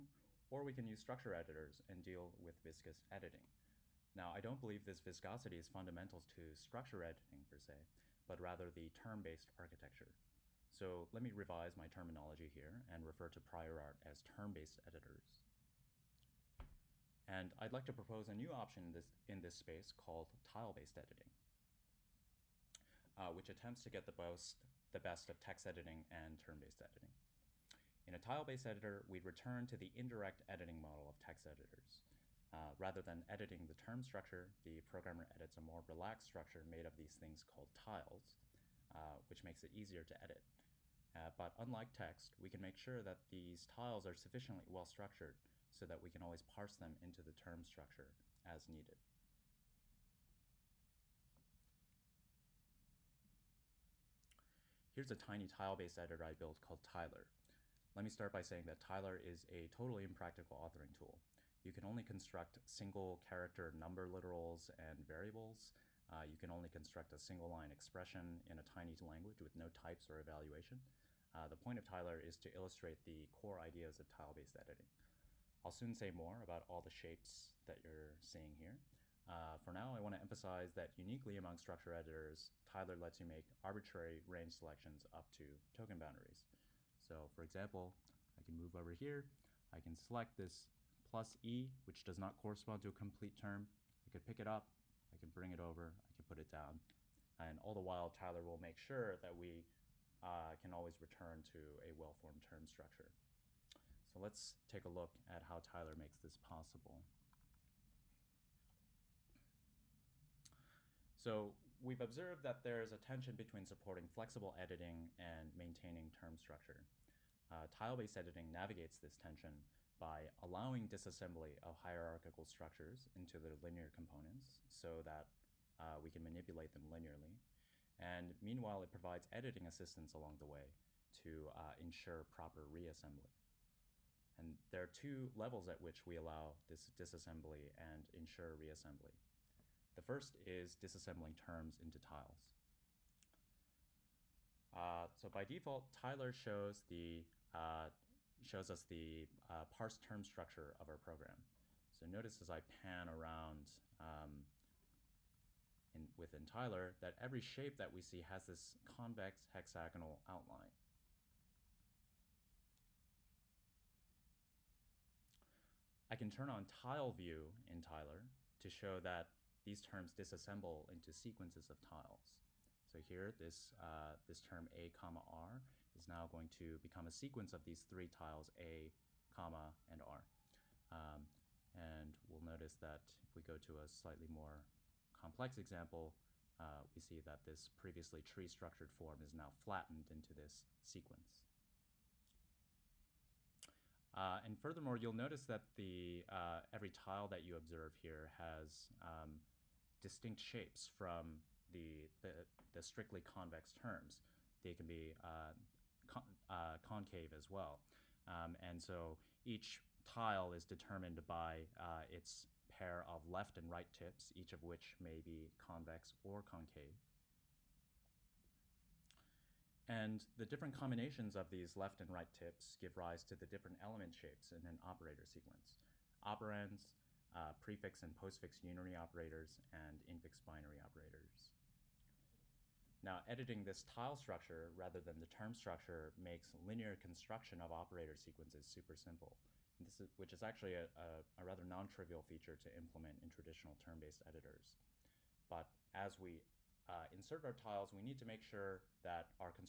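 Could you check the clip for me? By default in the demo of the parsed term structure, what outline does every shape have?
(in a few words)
convex hexagonal.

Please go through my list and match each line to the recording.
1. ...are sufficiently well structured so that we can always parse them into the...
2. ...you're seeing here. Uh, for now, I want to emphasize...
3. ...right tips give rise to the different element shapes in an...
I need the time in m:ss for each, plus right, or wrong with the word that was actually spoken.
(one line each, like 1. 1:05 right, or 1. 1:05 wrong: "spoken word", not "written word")
1. 0:44 right
2. 1:17 right
3. 3:42 right.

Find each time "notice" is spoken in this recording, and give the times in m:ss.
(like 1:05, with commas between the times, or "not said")
2:32, 3:02, 3:15.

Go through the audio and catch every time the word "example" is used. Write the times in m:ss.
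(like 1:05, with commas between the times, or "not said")
1:27, 3:05.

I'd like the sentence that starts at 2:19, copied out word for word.
The first is disassembling terms into tiles.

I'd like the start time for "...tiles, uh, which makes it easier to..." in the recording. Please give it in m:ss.
0:37.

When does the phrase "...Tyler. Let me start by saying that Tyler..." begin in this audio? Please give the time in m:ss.
0:56.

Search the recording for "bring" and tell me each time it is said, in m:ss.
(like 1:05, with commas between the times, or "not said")
1:35.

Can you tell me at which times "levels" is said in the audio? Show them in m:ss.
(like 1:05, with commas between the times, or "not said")
2:15.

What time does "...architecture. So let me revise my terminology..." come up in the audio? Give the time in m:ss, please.
0:09.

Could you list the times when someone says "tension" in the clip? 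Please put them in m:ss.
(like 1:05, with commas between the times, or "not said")
1:52, 1:59.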